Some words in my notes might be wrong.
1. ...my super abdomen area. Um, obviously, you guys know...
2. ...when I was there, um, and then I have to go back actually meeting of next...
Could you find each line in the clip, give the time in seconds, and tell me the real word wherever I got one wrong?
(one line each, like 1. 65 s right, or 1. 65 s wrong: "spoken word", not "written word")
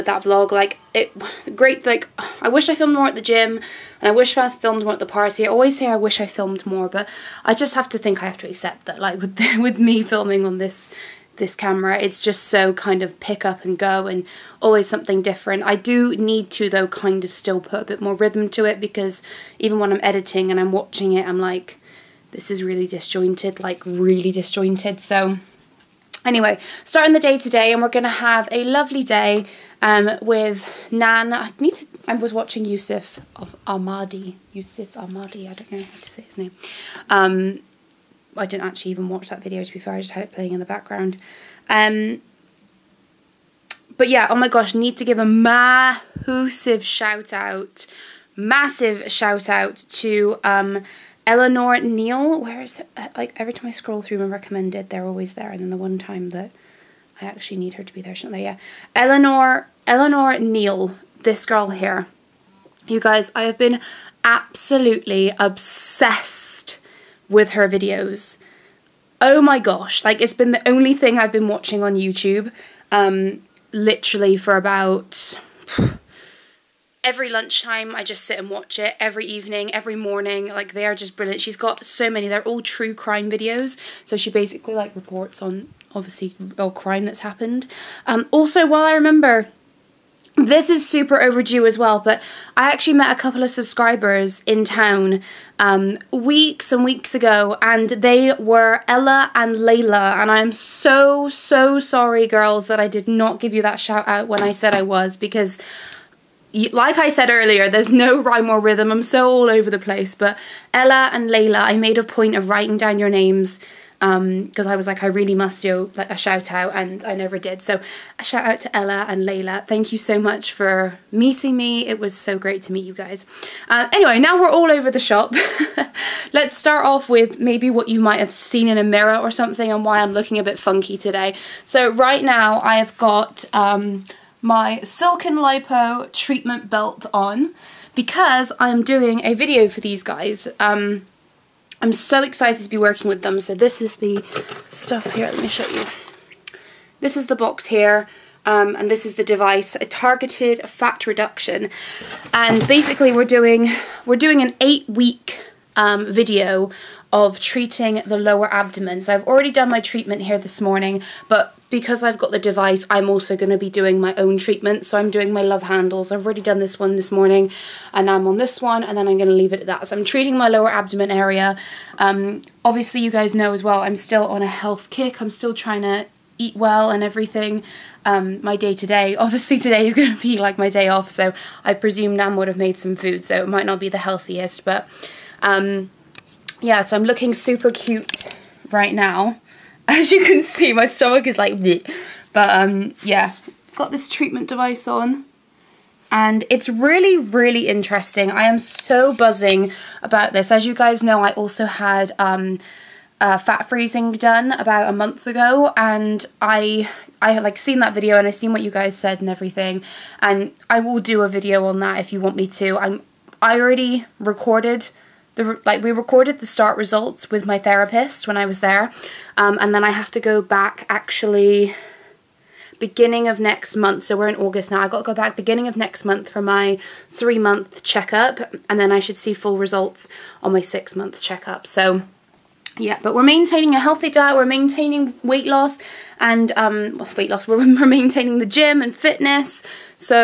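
1. 170 s wrong: "lower", not "super"
2. 218 s wrong: "beginning", not "meeting".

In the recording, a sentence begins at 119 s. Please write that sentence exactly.
Thank you so much for meeting me.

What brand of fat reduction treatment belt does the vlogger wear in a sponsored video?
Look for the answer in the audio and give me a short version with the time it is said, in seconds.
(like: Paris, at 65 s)
Silk'n Lipo, at 134 s.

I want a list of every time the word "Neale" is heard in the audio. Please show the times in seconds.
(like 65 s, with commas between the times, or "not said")
51 s, 60 s.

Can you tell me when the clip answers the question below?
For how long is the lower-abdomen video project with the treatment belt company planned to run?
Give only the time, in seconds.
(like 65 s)
154 s.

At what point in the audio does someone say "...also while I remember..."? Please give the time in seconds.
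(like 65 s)
88 s.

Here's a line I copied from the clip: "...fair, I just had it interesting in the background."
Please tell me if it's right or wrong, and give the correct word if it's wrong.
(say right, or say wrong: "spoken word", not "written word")
wrong: "playing", not "interesting".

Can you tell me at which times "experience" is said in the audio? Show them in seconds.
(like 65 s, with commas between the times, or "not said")
not said.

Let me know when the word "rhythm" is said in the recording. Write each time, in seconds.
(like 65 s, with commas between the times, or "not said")
18 s, 108 s.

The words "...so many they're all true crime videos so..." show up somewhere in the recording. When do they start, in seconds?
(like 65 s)
81 s.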